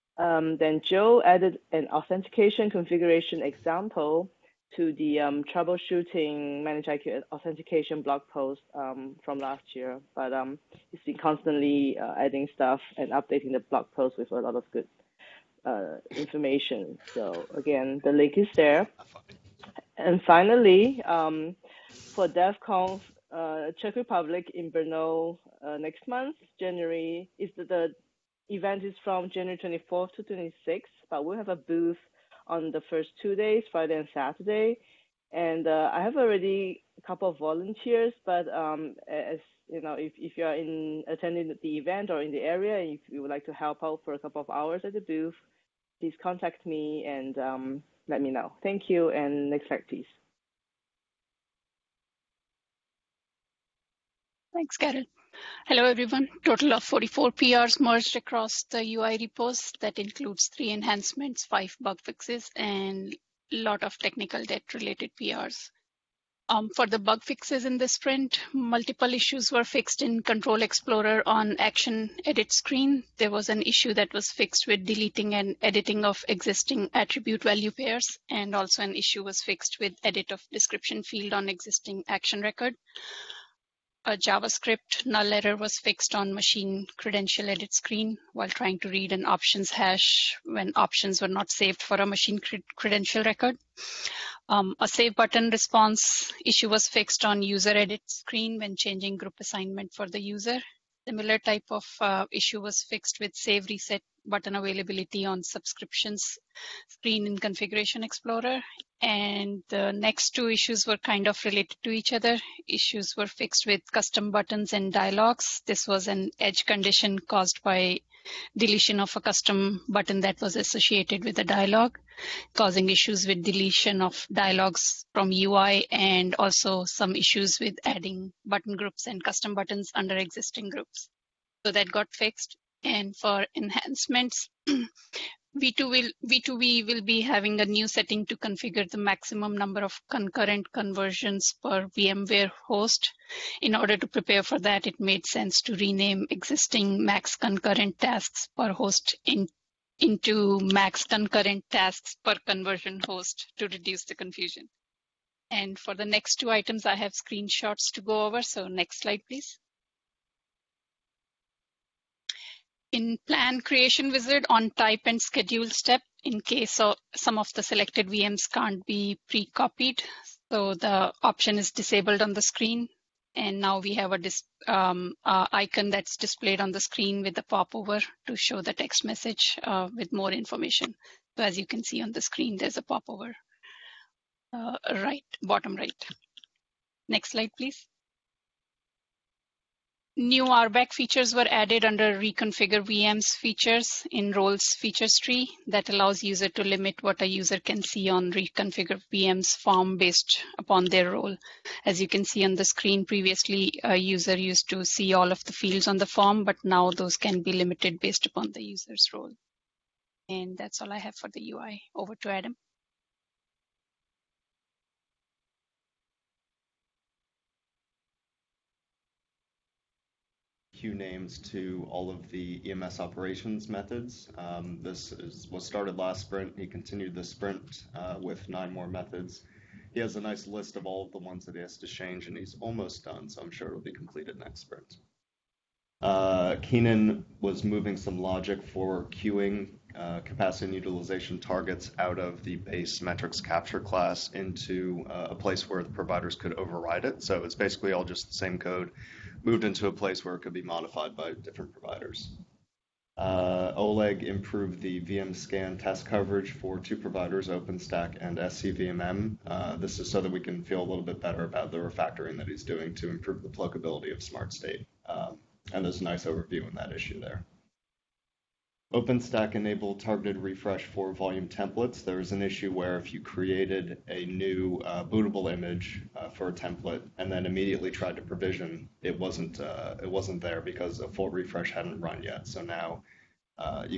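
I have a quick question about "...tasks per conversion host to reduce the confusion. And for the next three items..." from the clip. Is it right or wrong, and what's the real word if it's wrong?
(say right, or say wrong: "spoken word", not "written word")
wrong: "two", not "three".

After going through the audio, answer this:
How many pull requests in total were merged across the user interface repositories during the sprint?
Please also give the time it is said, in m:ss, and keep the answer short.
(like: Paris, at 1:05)
44, at 0:56.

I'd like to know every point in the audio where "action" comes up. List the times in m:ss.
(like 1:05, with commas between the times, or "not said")
1:11, 1:22.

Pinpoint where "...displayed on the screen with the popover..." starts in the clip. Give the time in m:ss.
2:56.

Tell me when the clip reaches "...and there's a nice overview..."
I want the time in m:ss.
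4:25.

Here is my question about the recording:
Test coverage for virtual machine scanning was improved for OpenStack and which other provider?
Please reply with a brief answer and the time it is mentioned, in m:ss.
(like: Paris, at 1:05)
SCVMM, at 4:18.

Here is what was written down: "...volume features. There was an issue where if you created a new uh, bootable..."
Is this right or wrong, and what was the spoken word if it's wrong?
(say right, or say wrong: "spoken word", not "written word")
wrong: "templates", not "features".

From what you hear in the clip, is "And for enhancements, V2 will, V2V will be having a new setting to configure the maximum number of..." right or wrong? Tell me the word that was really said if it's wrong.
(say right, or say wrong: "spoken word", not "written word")
right.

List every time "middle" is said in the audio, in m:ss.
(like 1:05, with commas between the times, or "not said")
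not said.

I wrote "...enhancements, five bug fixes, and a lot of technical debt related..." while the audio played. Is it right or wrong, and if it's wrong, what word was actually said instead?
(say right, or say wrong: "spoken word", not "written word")
right.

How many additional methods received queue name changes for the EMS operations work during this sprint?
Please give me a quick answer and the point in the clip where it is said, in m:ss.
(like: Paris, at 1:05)
9, at 3:48.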